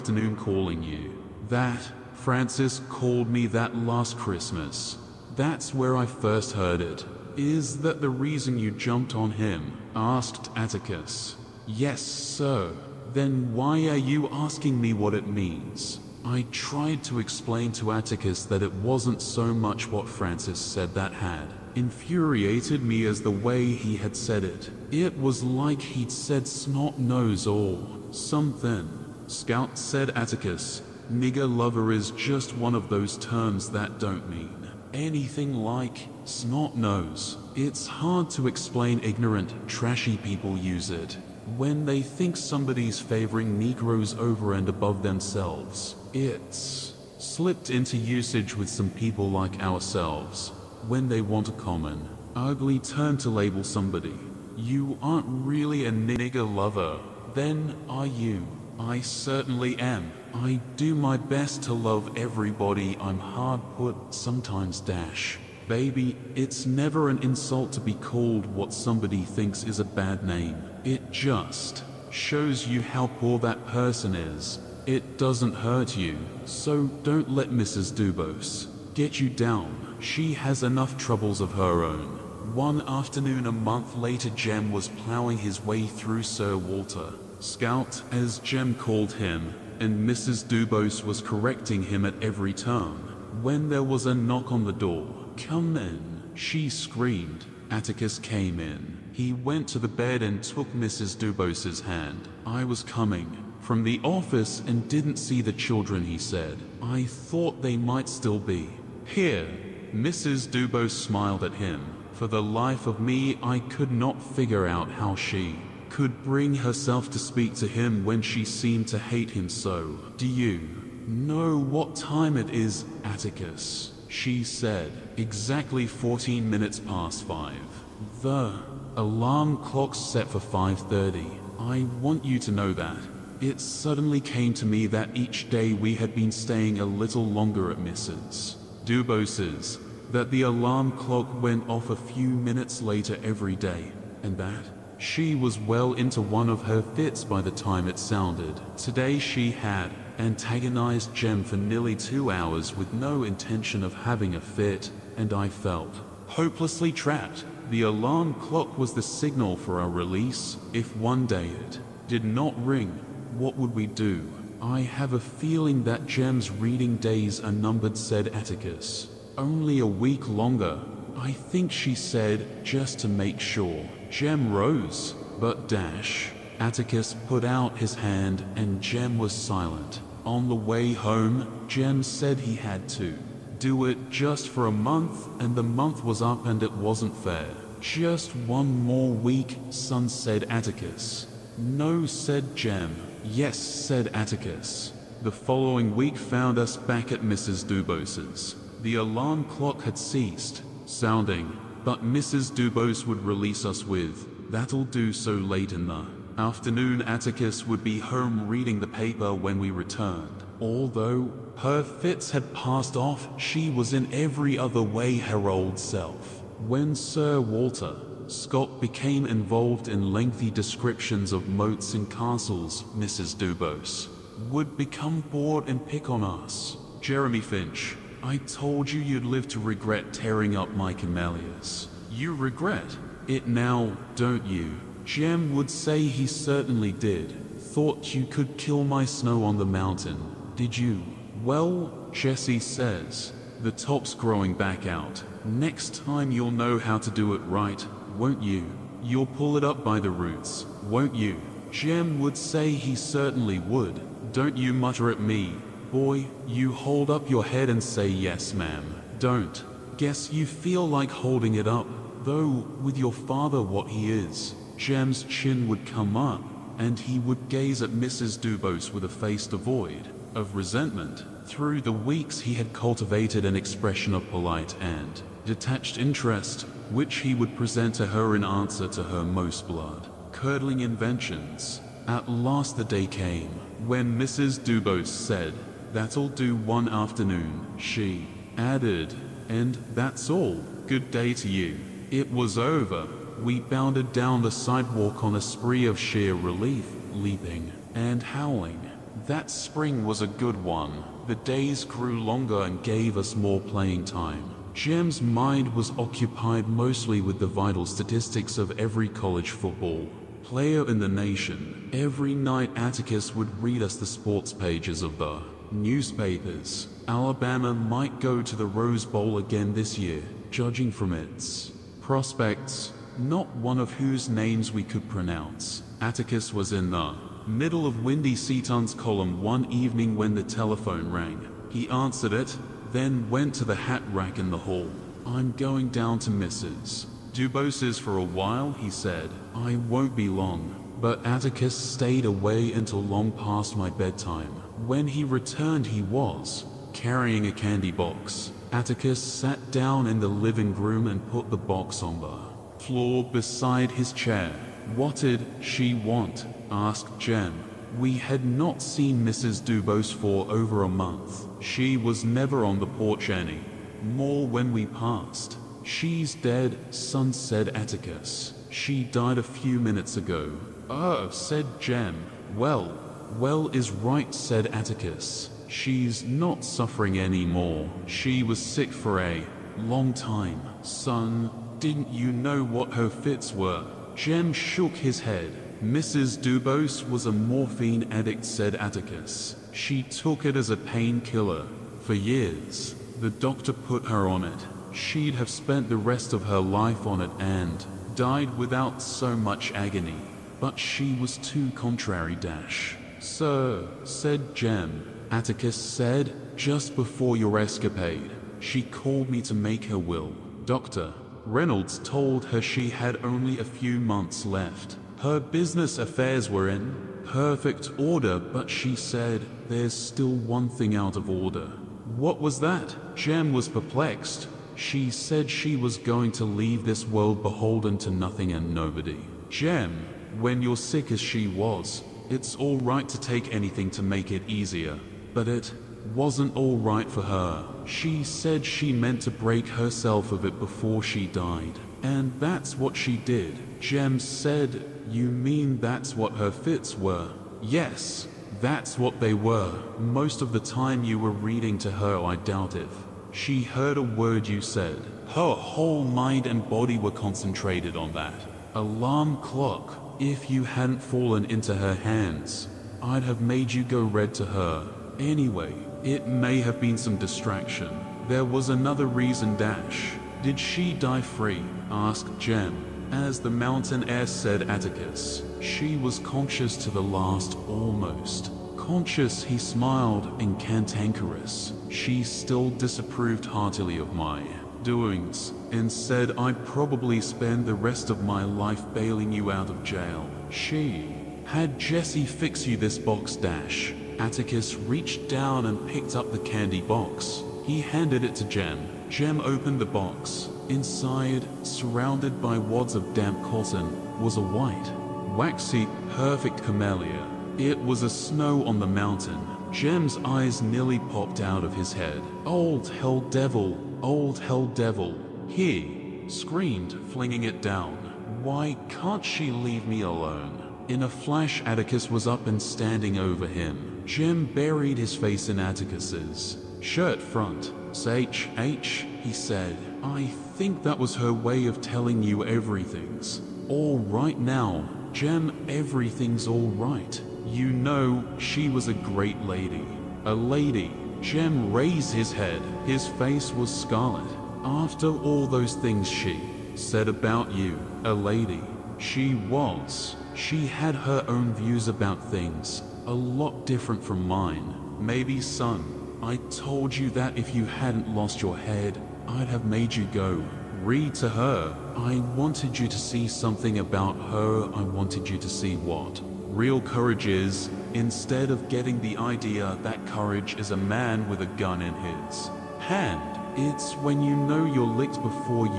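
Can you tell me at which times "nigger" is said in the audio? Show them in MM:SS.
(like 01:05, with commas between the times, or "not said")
00:31, 00:55.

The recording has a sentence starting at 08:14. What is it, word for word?
Atticus reached down and picked up the candy box.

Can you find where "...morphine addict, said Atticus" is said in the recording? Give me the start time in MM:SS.
06:27.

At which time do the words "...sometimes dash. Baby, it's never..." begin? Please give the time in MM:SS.
01:04.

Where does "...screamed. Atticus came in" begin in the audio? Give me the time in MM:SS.
01:36.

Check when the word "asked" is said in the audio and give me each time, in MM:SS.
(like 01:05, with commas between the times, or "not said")
00:09, 05:56, 07:51.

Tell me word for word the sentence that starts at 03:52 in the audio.
You regret it now, don't you?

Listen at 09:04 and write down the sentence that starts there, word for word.
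After all those things she said about you, a lady.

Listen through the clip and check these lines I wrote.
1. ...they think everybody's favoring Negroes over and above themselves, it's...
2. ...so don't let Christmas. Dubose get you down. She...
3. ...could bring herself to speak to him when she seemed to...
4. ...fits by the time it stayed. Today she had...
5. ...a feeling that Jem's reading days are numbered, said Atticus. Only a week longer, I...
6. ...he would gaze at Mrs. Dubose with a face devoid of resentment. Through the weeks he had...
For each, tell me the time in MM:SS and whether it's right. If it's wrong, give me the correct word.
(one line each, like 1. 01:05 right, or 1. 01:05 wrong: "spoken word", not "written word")
1. 00:41 wrong: "somebody", not "everybody"
2. 01:16 wrong: "Mrs", not "Christmas"
3. 01:55 right
4. 02:26 wrong: "sounded", not "stayed"
5. 02:45 right
6. 04:26 right.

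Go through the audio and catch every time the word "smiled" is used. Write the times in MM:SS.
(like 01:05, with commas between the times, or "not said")
01:50, 07:59.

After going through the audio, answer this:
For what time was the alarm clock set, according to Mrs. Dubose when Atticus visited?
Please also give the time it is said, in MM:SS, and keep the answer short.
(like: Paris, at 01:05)
5:30, at 02:10.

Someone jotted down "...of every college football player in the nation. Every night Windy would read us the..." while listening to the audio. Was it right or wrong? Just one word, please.
wrong.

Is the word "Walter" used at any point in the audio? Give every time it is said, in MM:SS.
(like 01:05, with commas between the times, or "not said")
01:26, 03:37.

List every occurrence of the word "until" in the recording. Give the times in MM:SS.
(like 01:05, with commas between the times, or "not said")
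05:42.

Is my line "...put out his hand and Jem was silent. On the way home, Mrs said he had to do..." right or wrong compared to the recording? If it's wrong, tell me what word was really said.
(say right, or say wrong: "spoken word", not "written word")
wrong: "Jem", not "Mrs".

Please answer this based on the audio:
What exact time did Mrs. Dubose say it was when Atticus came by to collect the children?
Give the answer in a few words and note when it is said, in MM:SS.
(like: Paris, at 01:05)
5:14, at 02:05.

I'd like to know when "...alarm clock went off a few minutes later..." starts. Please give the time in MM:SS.
02:20.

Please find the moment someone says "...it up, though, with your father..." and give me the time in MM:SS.
04:21.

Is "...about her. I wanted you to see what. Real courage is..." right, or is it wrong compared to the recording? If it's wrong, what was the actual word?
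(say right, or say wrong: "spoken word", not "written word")
right.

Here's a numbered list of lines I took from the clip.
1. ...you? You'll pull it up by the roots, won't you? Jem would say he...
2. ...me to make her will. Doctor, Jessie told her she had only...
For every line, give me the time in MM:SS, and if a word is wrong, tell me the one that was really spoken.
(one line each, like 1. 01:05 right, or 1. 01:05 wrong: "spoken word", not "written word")
1. 04:08 right
2. 06:49 wrong: "Reynolds", not "Jessie".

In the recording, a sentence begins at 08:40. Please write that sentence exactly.
In a flash, Atticus was up and standing over him.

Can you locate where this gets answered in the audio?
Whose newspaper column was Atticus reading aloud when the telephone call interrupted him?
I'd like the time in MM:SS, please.
05:28.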